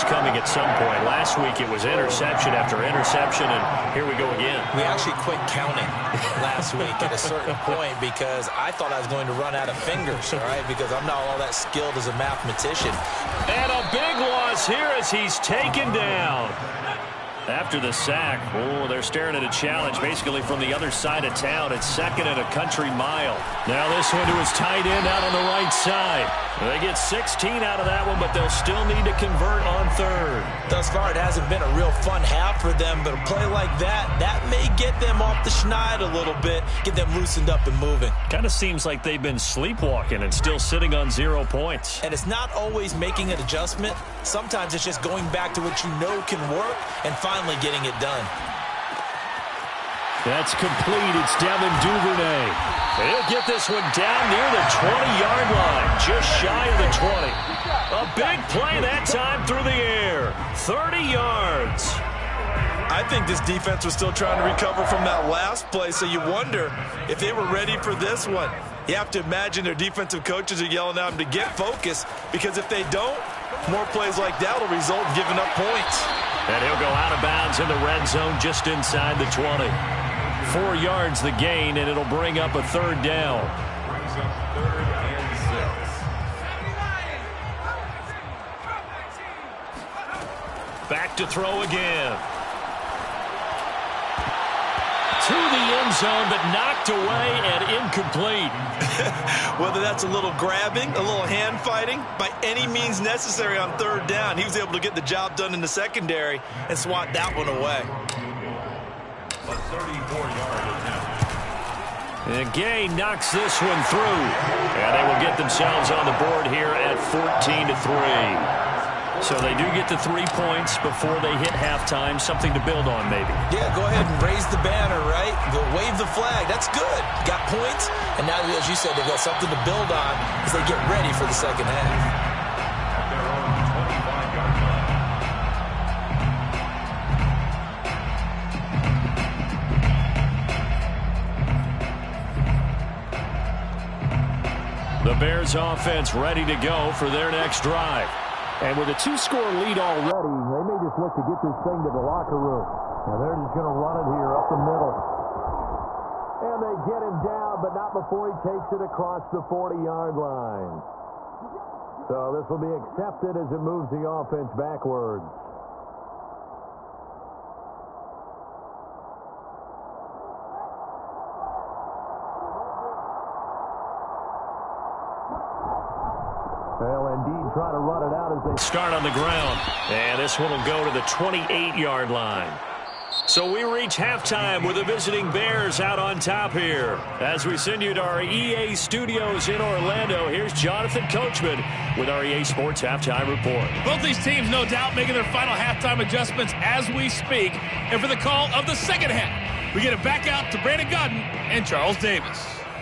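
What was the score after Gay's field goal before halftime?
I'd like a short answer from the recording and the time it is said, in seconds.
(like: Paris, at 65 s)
14 to 3, at 117 s.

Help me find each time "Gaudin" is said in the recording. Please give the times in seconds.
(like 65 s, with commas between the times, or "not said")
200 s.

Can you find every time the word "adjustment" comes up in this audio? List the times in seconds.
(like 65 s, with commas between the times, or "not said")
43 s, 196 s.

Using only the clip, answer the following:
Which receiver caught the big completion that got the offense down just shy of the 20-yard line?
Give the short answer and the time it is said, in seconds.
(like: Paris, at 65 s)
Devin Duvernay, at 51 s.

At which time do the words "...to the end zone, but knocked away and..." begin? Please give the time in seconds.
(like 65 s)
95 s.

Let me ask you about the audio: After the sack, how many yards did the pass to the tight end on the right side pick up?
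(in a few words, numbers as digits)
16.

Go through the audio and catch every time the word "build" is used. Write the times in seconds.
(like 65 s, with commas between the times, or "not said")
122 s, 129 s.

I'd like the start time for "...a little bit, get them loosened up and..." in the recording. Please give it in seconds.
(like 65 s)
35 s.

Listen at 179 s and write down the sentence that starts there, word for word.
And this one will go to the 28-yard line.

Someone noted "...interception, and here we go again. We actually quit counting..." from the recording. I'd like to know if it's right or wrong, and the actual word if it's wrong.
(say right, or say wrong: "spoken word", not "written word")
right.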